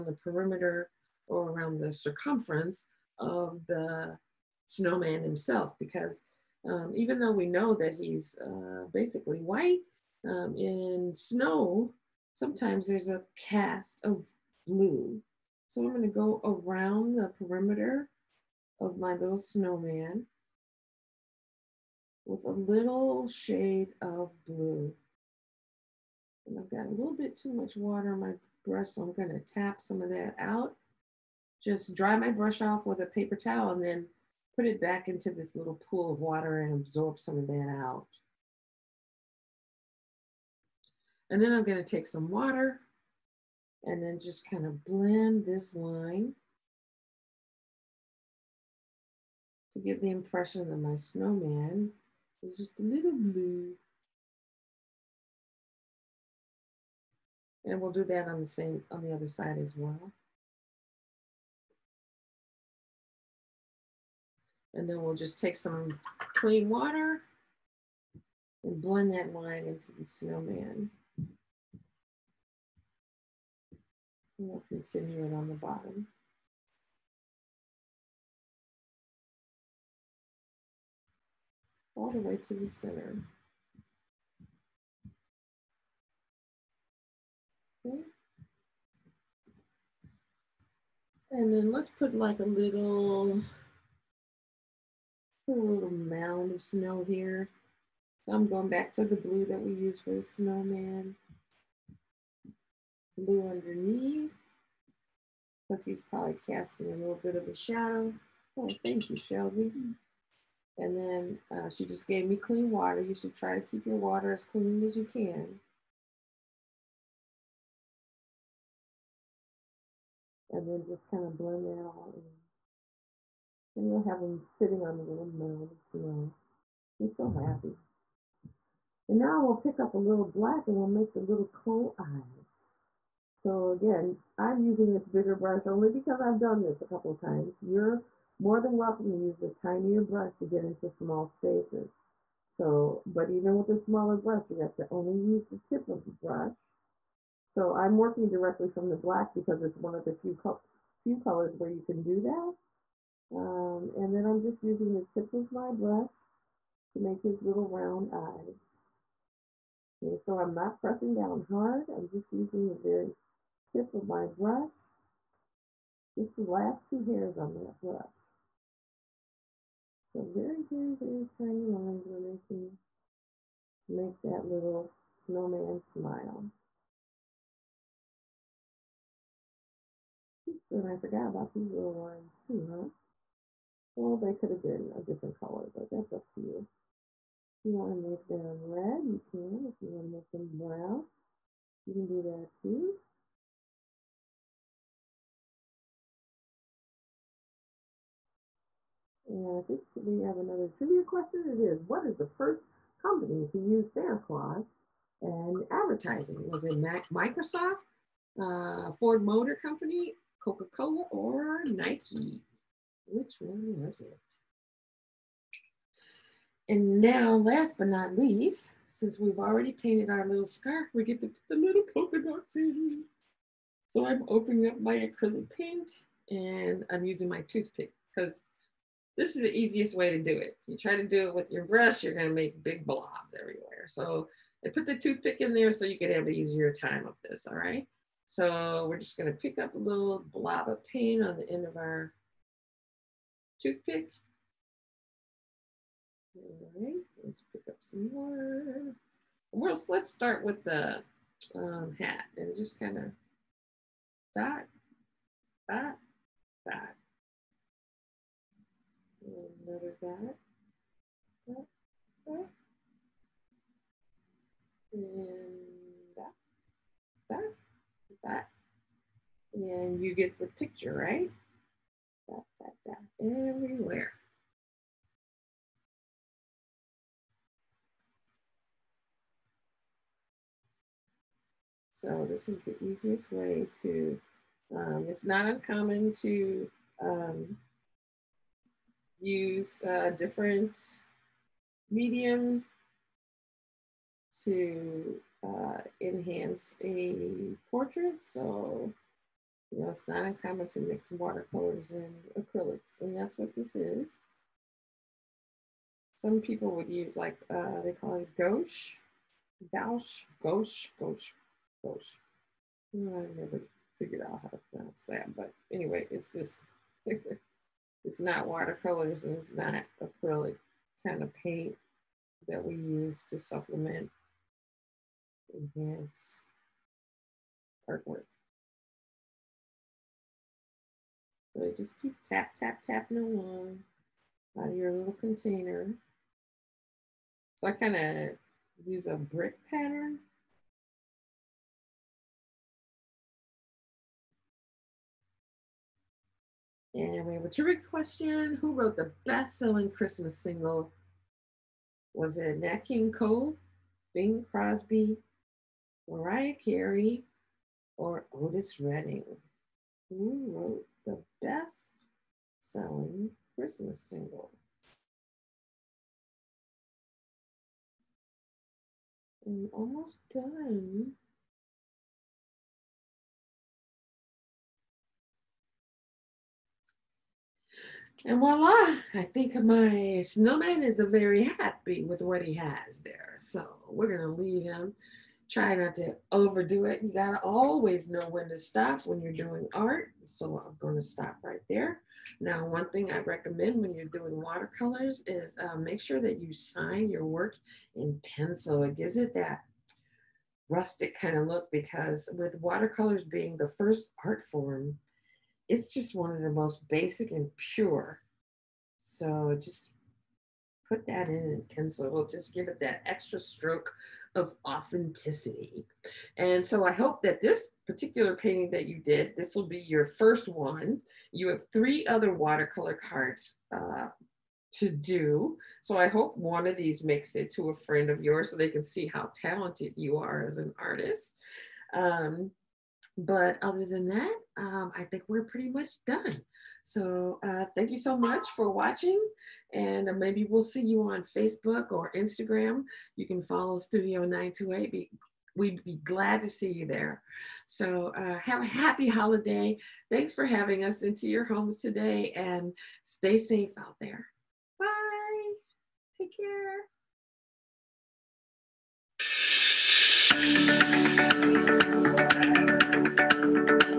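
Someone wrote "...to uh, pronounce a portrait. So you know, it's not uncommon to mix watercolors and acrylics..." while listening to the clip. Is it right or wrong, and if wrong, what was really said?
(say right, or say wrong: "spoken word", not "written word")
wrong: "enhance", not "pronounce".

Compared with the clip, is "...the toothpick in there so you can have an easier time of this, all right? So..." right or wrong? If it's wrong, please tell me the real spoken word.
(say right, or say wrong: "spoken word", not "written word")
right.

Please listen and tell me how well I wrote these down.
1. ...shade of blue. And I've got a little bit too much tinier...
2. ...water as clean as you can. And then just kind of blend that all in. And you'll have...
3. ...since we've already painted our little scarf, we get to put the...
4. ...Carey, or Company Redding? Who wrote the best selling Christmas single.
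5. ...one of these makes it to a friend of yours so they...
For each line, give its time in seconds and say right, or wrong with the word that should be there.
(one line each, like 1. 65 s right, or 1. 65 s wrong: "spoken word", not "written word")
1. 23 s wrong: "water", not "tinier"
2. 113 s right
3. 218 s right
4. 356 s wrong: "Otis", not "Company"
5. 426 s right.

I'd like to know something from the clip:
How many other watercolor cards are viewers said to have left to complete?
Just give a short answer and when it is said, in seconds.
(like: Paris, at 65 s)
3, at 421 s.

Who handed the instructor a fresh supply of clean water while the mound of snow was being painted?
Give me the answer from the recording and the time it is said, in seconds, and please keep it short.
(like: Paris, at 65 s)
Shelby, at 109 s.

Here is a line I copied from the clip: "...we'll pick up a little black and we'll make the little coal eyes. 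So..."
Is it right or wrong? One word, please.
right.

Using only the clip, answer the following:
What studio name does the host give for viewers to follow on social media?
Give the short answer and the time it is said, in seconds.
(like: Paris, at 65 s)
Studio 928, at 443 s.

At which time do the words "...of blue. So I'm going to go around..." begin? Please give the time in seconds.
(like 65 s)
14 s.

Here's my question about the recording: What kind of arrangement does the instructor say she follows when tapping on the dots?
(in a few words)
Brick pattern.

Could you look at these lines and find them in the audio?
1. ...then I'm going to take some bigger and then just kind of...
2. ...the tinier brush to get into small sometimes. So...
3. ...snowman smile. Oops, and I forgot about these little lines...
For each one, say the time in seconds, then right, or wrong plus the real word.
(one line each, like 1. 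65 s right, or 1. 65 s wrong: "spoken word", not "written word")
1. 41 s wrong: "water", not "bigger"
2. 139 s wrong: "spaces", not "sometimes"
3. 175 s right.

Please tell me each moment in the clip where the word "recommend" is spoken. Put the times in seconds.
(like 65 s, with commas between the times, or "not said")
393 s.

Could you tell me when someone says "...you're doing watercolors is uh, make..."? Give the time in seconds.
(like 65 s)
393 s.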